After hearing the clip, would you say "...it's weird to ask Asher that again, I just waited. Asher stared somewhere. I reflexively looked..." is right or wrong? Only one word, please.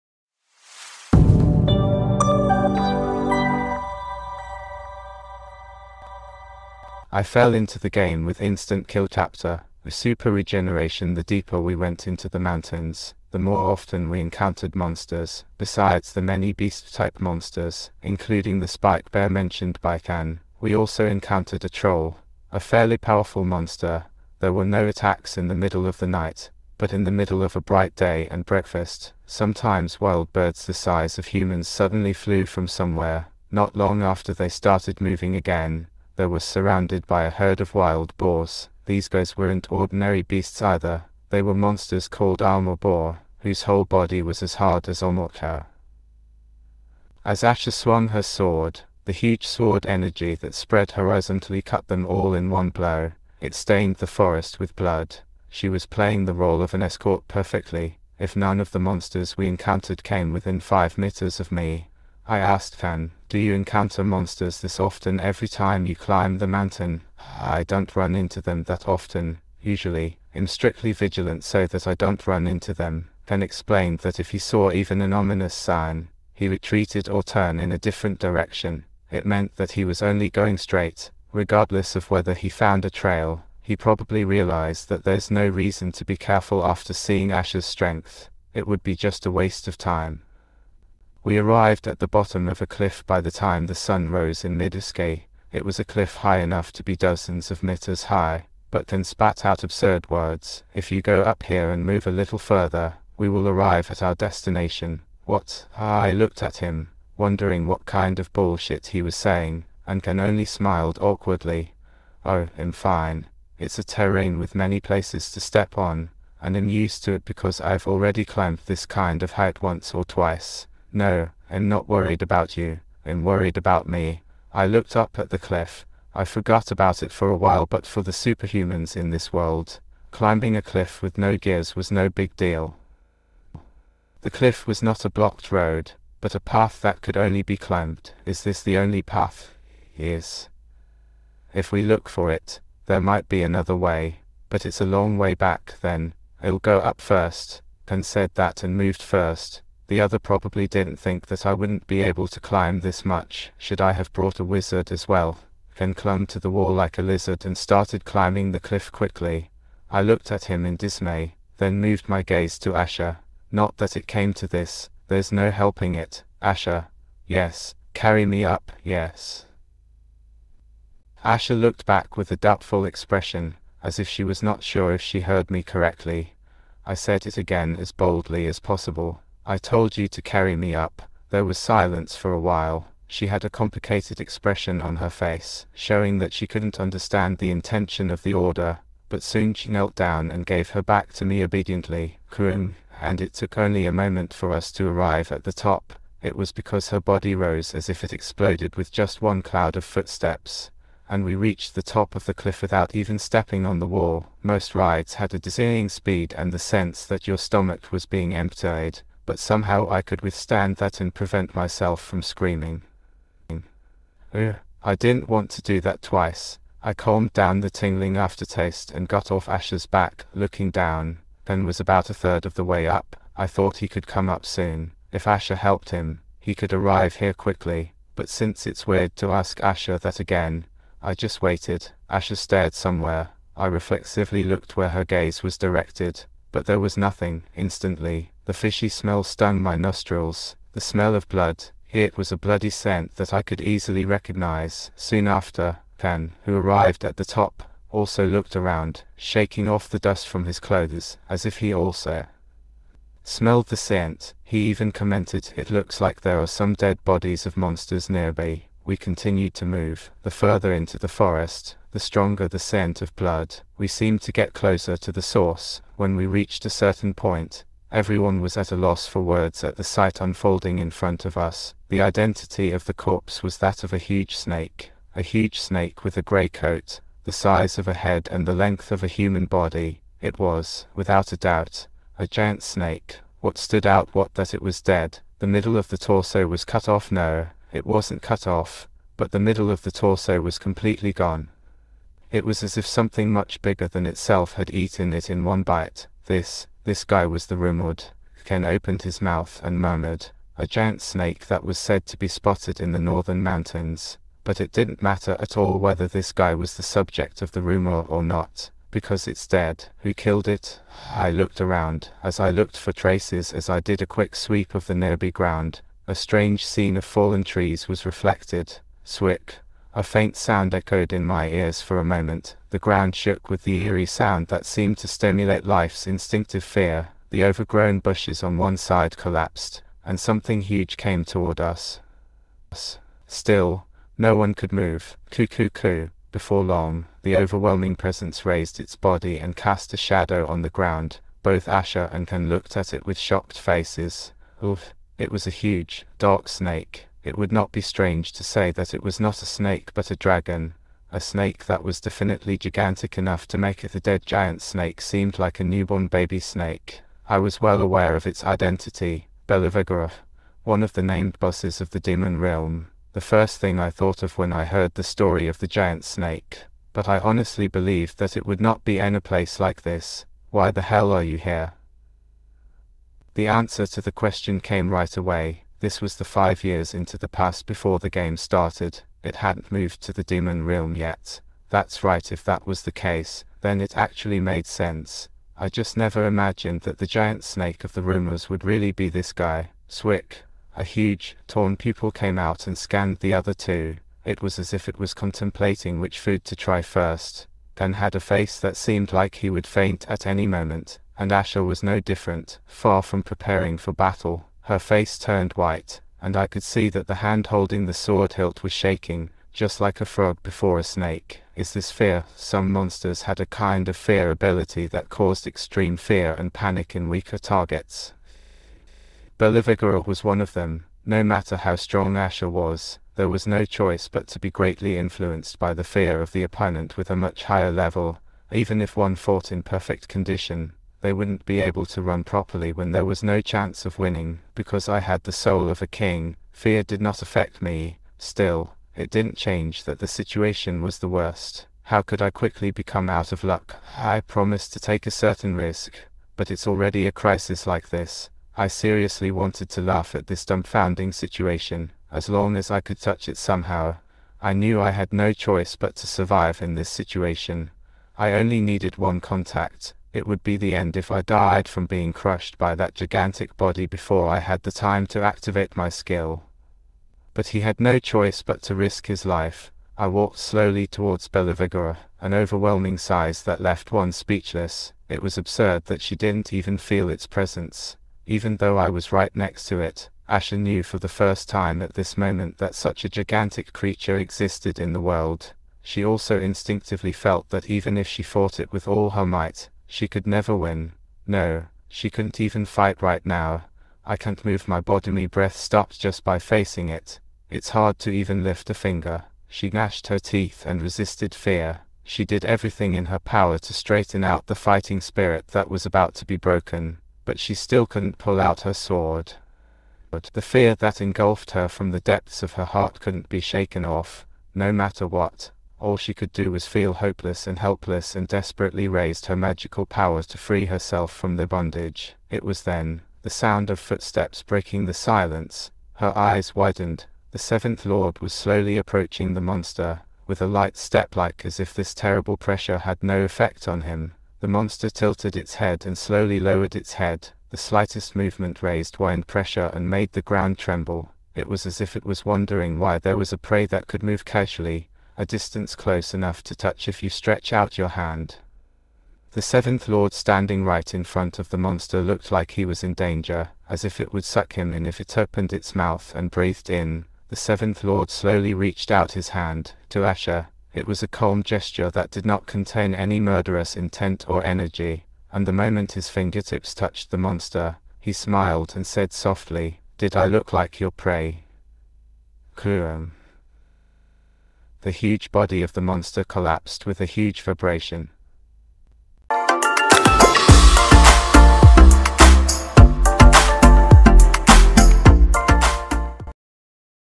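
right.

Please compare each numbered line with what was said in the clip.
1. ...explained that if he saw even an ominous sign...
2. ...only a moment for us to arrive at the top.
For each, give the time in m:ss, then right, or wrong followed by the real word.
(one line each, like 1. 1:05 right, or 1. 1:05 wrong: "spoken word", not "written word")
1. 1:13 right
2. 3:13 right.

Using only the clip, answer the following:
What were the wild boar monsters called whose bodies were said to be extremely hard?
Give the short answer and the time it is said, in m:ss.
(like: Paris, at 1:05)
almabore, at 0:42.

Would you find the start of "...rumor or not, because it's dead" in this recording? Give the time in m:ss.
5:07.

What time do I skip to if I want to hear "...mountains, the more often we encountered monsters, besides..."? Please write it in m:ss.
0:12.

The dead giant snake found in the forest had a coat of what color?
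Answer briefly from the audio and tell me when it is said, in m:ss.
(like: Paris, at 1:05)
grey, at 4:36.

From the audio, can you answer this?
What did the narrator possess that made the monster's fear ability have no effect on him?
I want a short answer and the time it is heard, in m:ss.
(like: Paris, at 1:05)
soul of a king, at 7:15.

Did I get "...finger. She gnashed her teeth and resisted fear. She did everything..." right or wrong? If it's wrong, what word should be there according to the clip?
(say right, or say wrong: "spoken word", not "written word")
right.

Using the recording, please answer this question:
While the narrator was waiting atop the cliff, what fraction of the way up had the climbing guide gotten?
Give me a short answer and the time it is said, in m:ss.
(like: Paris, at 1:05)
a third, at 3:42.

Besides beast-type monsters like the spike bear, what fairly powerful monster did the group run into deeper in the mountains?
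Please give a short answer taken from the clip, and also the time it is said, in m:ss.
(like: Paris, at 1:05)
troll, at 0:21.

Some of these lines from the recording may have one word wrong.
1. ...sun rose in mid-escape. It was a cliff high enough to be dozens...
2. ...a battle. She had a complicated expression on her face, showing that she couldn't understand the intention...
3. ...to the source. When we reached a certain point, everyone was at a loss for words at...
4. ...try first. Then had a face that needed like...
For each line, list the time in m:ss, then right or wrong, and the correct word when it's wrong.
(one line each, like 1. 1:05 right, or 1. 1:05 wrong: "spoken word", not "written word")
1. 1:33 right
2. 3:02 wrong: "while", not "battle"
3. 4:24 right
4. 6:36 wrong: "seemed", not "needed".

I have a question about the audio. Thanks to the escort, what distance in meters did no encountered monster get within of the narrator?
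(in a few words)
5.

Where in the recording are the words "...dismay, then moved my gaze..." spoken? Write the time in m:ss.
2:40.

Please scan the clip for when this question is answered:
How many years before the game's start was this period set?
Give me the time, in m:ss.
6:16.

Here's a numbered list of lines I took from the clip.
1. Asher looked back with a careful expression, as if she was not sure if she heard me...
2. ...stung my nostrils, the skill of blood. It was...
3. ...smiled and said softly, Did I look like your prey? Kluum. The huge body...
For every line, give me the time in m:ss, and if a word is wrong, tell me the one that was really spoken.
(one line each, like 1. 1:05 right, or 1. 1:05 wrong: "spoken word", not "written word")
1. 2:51 wrong: "doubtful", not "careful"
2. 3:59 wrong: "smell", not "skill"
3. 9:28 right.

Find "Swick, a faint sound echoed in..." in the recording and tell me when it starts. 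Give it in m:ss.
5:19.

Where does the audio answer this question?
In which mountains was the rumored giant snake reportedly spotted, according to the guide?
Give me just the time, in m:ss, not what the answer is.
5:02.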